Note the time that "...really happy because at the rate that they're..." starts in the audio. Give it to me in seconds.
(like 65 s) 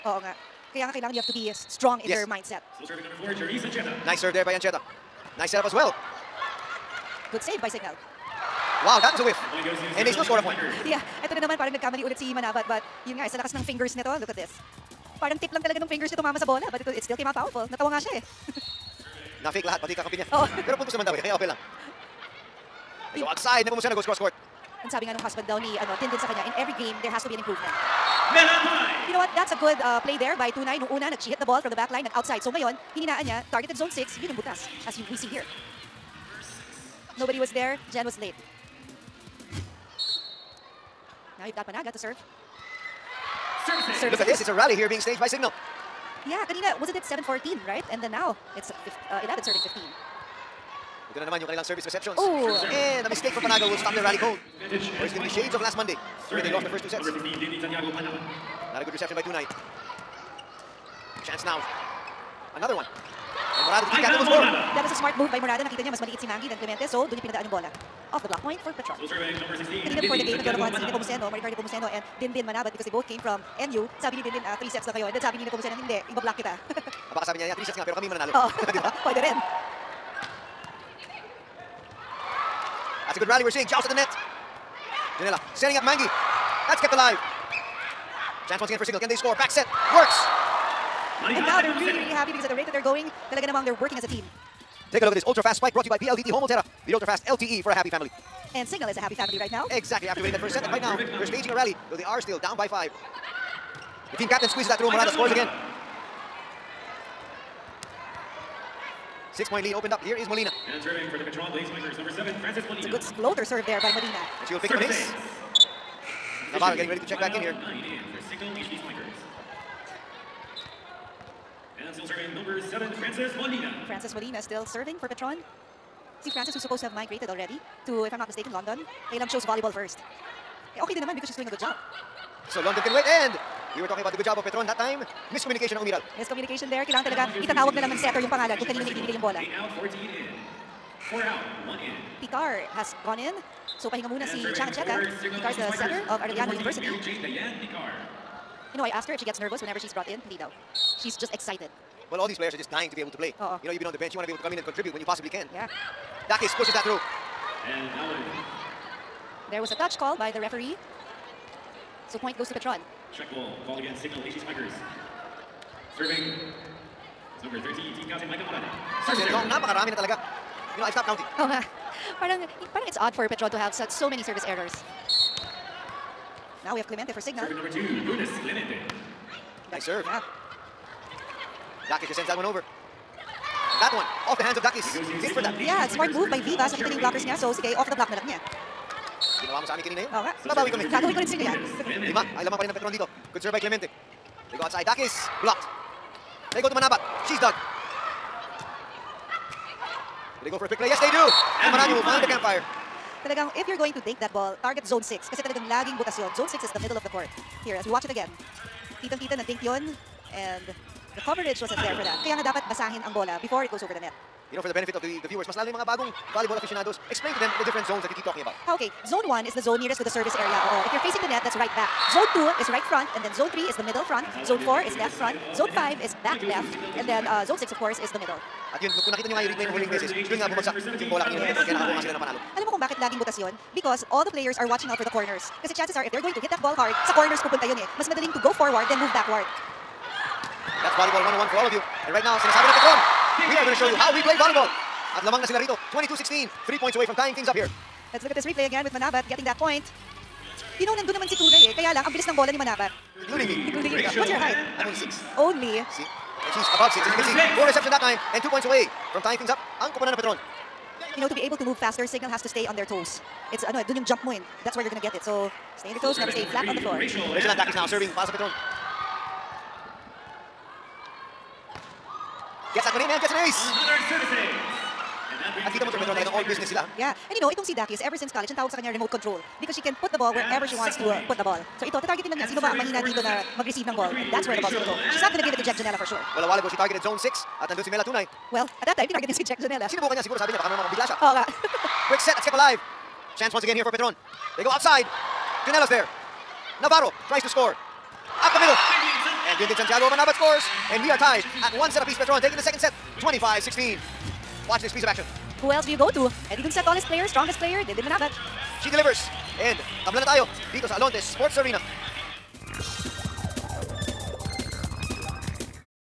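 91 s.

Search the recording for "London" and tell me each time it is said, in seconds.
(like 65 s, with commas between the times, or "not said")
128 s, 132 s.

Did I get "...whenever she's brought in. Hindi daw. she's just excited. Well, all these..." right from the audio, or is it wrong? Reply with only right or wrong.
right.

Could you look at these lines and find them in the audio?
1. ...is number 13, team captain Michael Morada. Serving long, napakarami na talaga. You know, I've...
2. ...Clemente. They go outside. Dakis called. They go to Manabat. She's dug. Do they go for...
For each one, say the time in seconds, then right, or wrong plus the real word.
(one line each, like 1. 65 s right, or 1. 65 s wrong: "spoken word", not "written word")
1. 167 s right
2. 193 s wrong: "blocked", not "called".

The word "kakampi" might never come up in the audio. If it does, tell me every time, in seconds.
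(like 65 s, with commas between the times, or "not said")
19 s.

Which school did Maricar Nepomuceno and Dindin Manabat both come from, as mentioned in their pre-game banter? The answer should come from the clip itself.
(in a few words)
NU.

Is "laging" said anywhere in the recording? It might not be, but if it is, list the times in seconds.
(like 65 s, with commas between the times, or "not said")
205 s, 232 s.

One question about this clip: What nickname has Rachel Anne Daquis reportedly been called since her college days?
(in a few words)
Remote control.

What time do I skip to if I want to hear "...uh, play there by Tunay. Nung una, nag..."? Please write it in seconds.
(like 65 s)
29 s.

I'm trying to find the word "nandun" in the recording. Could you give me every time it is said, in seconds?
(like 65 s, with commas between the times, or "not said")
250 s, 287 s.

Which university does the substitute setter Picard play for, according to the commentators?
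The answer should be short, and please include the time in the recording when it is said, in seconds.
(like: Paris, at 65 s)
Arellano University, at 146 s.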